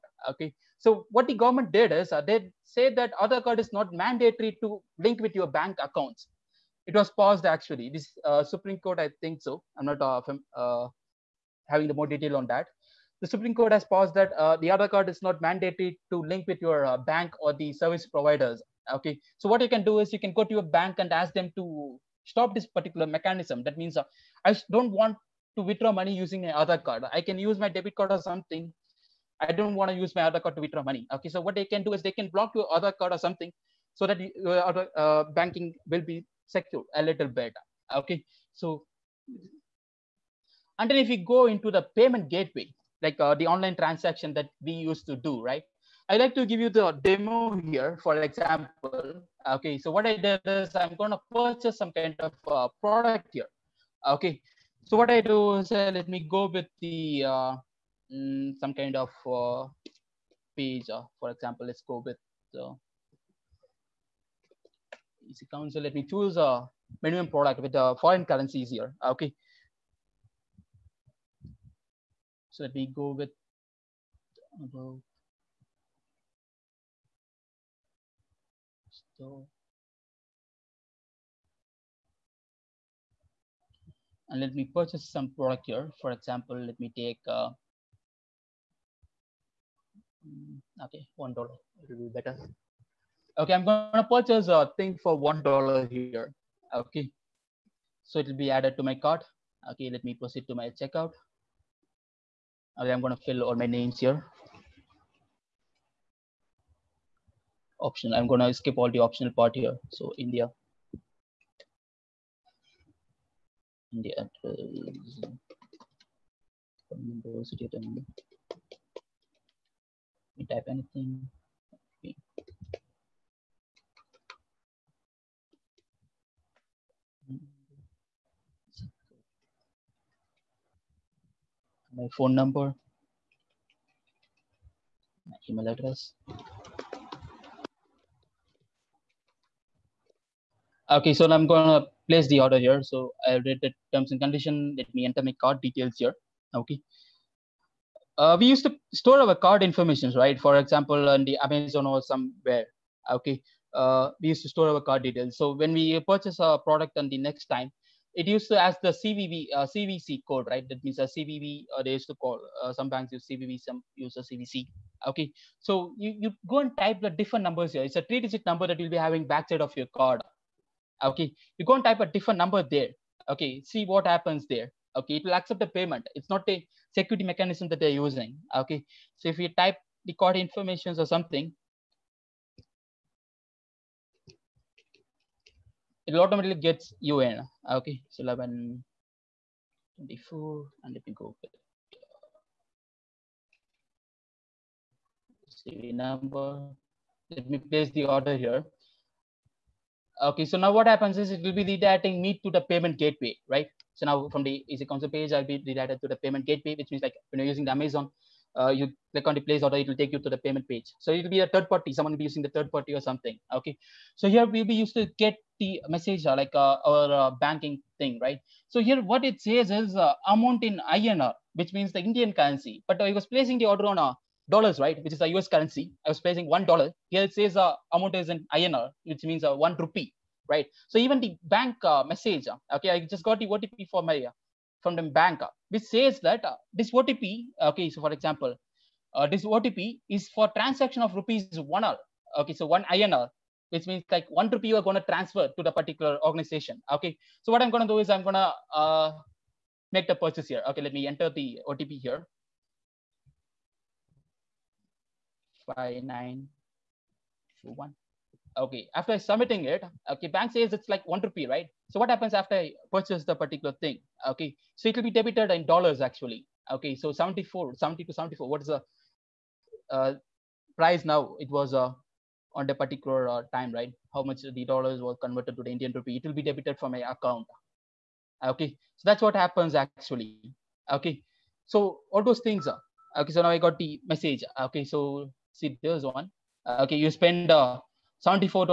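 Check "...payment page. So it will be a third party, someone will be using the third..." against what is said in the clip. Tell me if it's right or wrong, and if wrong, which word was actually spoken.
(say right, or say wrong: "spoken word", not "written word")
right.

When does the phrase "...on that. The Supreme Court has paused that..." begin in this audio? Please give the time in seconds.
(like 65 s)
12 s.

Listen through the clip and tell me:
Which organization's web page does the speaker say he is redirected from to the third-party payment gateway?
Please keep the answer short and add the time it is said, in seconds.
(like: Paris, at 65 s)
EC Council, at 204 s.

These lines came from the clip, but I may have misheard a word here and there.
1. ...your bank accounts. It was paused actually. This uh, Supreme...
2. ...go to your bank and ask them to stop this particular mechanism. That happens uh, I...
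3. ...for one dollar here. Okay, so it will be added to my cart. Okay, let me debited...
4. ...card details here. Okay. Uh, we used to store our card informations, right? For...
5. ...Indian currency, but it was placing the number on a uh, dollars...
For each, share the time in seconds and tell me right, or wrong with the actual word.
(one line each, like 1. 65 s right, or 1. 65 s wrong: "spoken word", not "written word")
1. 5 s right
2. 20 s wrong: "means", not "happens"
3. 95 s wrong: "proceed", not "debited"
4. 145 s right
5. 221 s wrong: "order", not "number".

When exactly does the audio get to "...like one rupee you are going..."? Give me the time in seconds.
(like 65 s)
244 s.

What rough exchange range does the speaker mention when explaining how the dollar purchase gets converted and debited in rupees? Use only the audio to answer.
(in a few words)
70 to 74.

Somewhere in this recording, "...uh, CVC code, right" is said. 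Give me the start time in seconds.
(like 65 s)
159 s.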